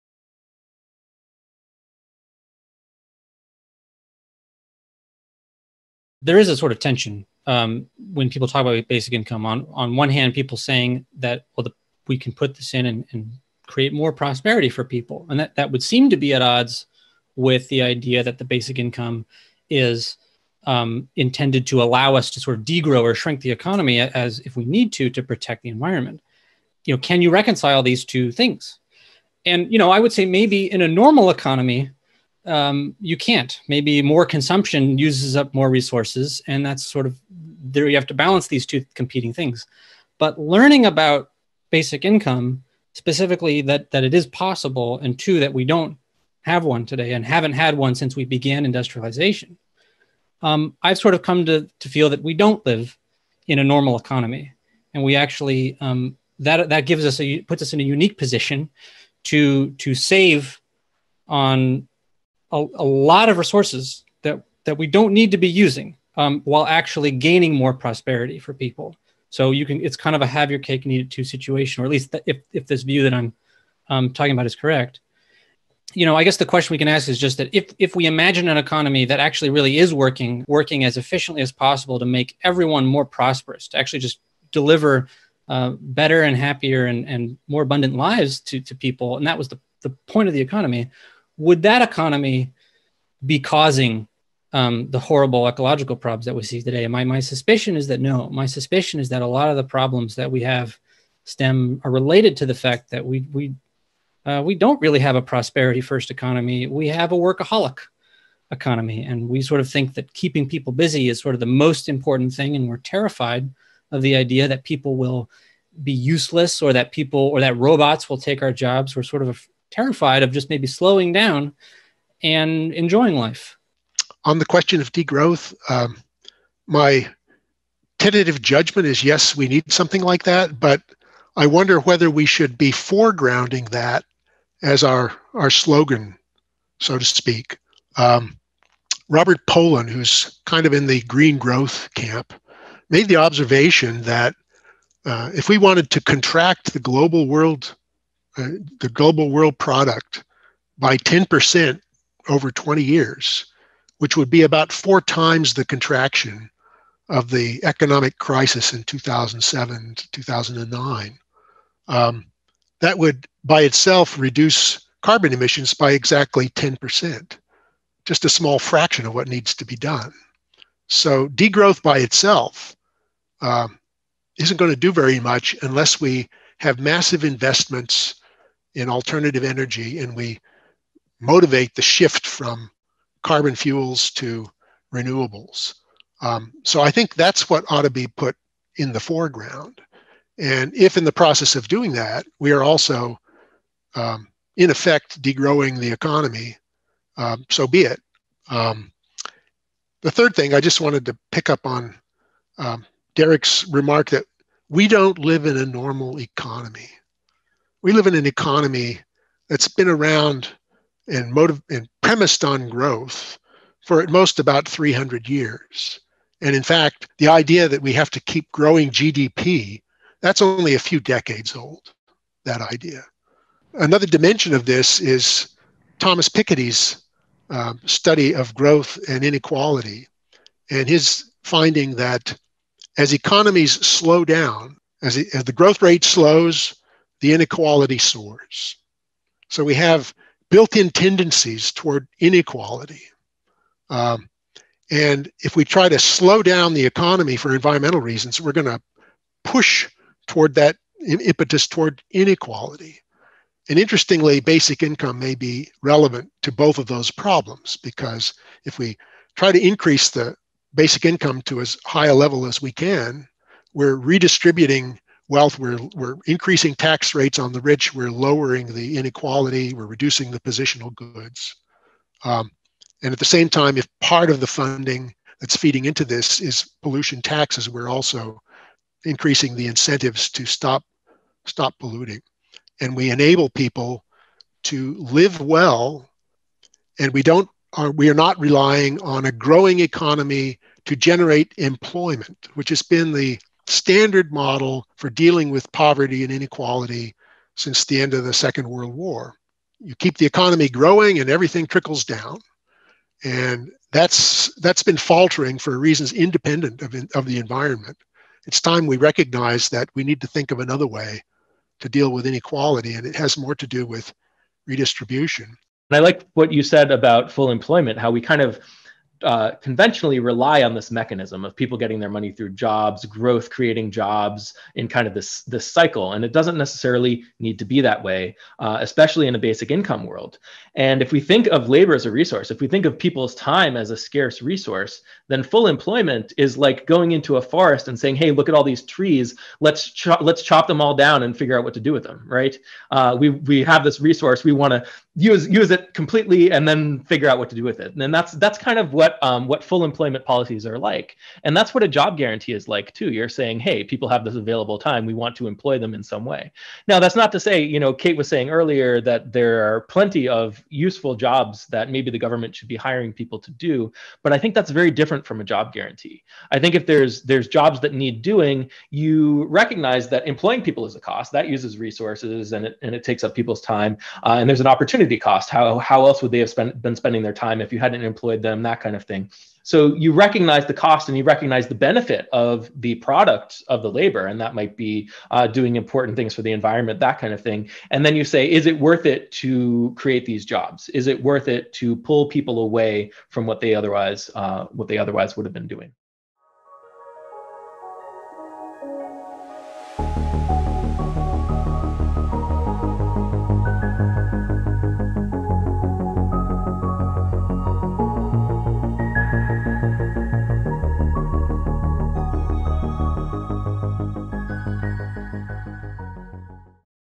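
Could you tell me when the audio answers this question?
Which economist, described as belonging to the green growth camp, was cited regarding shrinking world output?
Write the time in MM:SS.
02:19.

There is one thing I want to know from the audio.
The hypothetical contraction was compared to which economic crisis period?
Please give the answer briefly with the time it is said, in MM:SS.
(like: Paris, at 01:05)
2007 to 2009, at 02:38.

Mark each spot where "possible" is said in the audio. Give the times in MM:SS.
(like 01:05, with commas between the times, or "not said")
00:44, 01:21.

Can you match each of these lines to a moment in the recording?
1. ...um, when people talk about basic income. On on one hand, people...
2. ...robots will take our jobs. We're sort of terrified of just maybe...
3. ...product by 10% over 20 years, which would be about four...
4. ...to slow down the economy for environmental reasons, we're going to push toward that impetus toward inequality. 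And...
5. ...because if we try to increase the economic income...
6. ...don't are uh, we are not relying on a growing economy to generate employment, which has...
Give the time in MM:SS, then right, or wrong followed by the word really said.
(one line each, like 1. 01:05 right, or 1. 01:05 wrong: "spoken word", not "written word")
1. 00:07 right
2. 01:57 right
3. 02:29 right
4. 04:05 right
5. 04:17 wrong: "basic", not "economic"
6. 04:47 right.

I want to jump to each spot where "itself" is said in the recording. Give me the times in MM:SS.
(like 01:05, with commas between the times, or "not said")
02:43, 02:51.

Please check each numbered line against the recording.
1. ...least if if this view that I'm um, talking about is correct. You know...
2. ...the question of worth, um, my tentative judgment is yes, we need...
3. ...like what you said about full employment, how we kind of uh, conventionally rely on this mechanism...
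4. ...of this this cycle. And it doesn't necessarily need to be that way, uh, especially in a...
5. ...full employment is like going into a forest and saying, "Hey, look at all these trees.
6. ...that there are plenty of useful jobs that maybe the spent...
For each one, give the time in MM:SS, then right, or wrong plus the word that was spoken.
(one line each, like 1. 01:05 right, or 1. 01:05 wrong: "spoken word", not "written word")
1. 01:11 right
2. 02:04 wrong: "degrowth", not "worth"
3. 05:15 right
4. 05:25 right
5. 05:35 right
6. 05:59 wrong: "government", not "spent".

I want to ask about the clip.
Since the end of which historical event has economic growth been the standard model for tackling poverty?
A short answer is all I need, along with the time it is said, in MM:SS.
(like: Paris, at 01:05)
Second World War, at 04:58.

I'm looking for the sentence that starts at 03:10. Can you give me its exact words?
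And if in the process of doing that, we are also, um, in effect, degrowing the economy, um, so be it.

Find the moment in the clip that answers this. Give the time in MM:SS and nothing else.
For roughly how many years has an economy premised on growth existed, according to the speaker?
03:34.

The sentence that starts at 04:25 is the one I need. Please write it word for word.
We're, we're increasing tax rates on the rich.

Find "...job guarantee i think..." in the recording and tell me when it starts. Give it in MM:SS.
06:05.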